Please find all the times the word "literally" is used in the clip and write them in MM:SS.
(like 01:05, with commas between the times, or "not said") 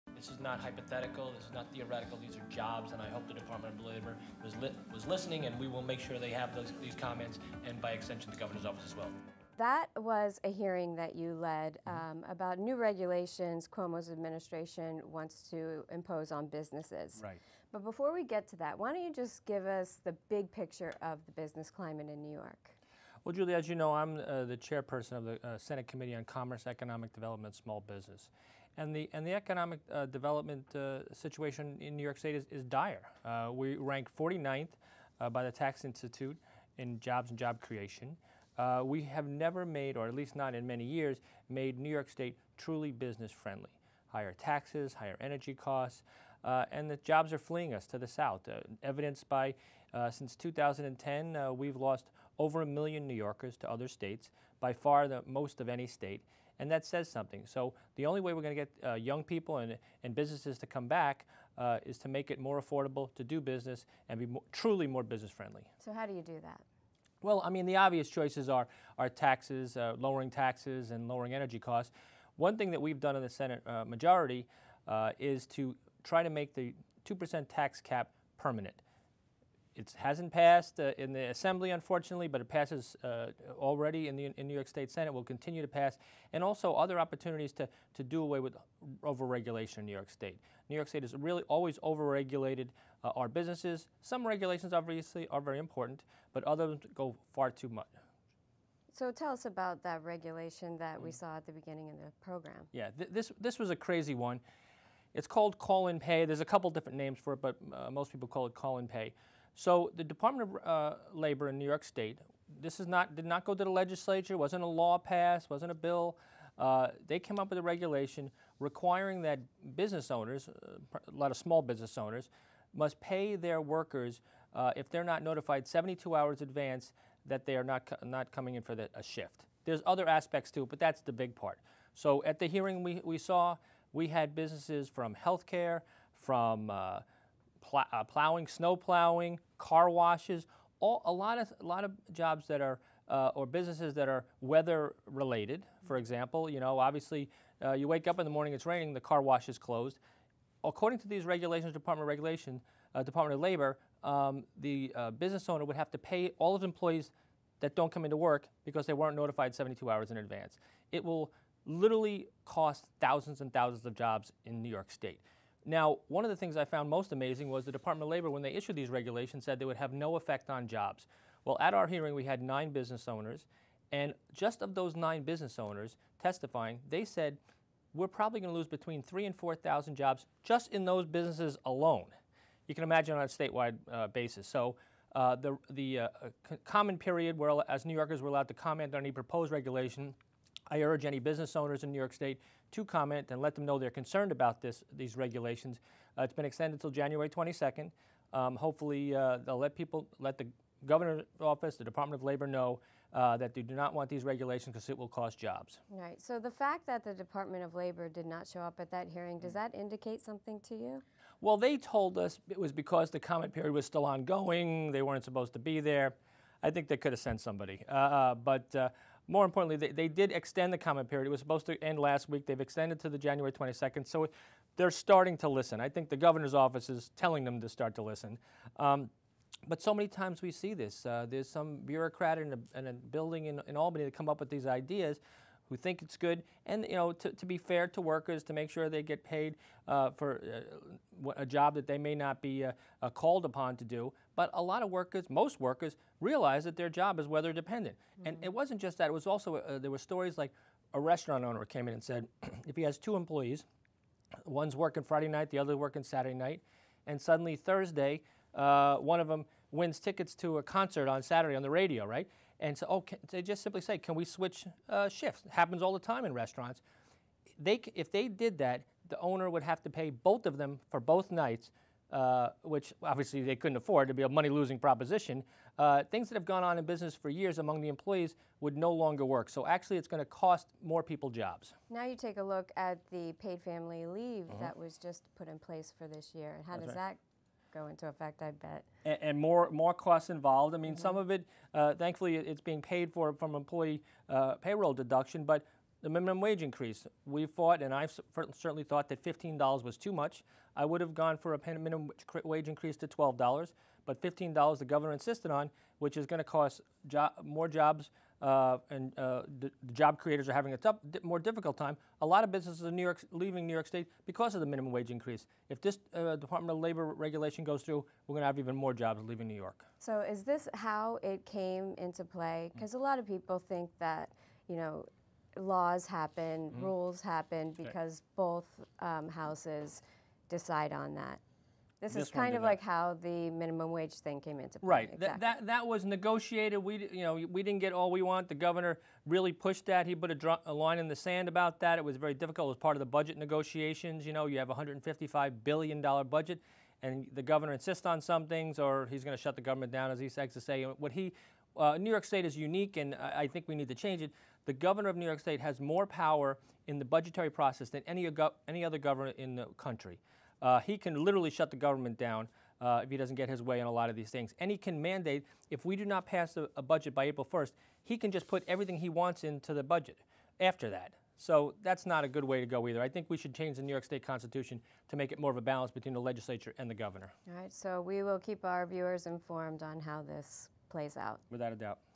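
02:41, 06:01.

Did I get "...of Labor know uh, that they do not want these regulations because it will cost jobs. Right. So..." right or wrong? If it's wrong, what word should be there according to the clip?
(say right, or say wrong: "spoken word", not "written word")
right.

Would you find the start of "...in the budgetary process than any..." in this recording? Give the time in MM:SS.
05:56.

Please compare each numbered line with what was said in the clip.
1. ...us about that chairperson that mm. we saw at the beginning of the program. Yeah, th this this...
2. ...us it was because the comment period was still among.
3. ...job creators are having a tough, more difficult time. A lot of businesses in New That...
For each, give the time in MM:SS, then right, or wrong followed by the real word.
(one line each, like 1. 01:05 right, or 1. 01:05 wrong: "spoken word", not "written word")
1. 01:39 wrong: "regulation", not "chairperson"
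2. 03:32 wrong: "ongoing", not "among"
3. 05:09 wrong: "York", not "That".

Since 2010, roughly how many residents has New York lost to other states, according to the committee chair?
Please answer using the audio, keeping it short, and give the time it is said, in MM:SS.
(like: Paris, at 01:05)
over a million, at 00:52.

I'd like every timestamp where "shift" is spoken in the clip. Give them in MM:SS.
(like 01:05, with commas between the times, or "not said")
02:09, 04:25.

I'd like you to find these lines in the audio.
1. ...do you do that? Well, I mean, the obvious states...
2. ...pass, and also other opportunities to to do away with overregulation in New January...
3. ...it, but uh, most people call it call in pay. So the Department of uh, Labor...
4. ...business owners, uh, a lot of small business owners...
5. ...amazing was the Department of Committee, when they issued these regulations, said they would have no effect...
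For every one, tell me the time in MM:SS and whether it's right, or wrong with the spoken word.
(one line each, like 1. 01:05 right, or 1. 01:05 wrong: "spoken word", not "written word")
1. 01:06 wrong: "choices", not "states"
2. 01:25 wrong: "York", not "January"
3. 01:47 right
4. 01:59 right
5. 02:47 wrong: "Labor", not "Committee".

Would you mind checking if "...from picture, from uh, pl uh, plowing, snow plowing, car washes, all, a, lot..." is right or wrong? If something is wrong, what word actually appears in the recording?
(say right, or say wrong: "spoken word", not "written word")
wrong: "healthcare", not "picture".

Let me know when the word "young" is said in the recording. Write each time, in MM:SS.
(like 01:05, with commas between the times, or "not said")
00:58.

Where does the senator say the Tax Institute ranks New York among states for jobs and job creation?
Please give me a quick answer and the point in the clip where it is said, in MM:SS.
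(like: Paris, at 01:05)
49th, at 00:34.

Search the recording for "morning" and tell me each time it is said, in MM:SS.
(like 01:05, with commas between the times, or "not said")
02:28.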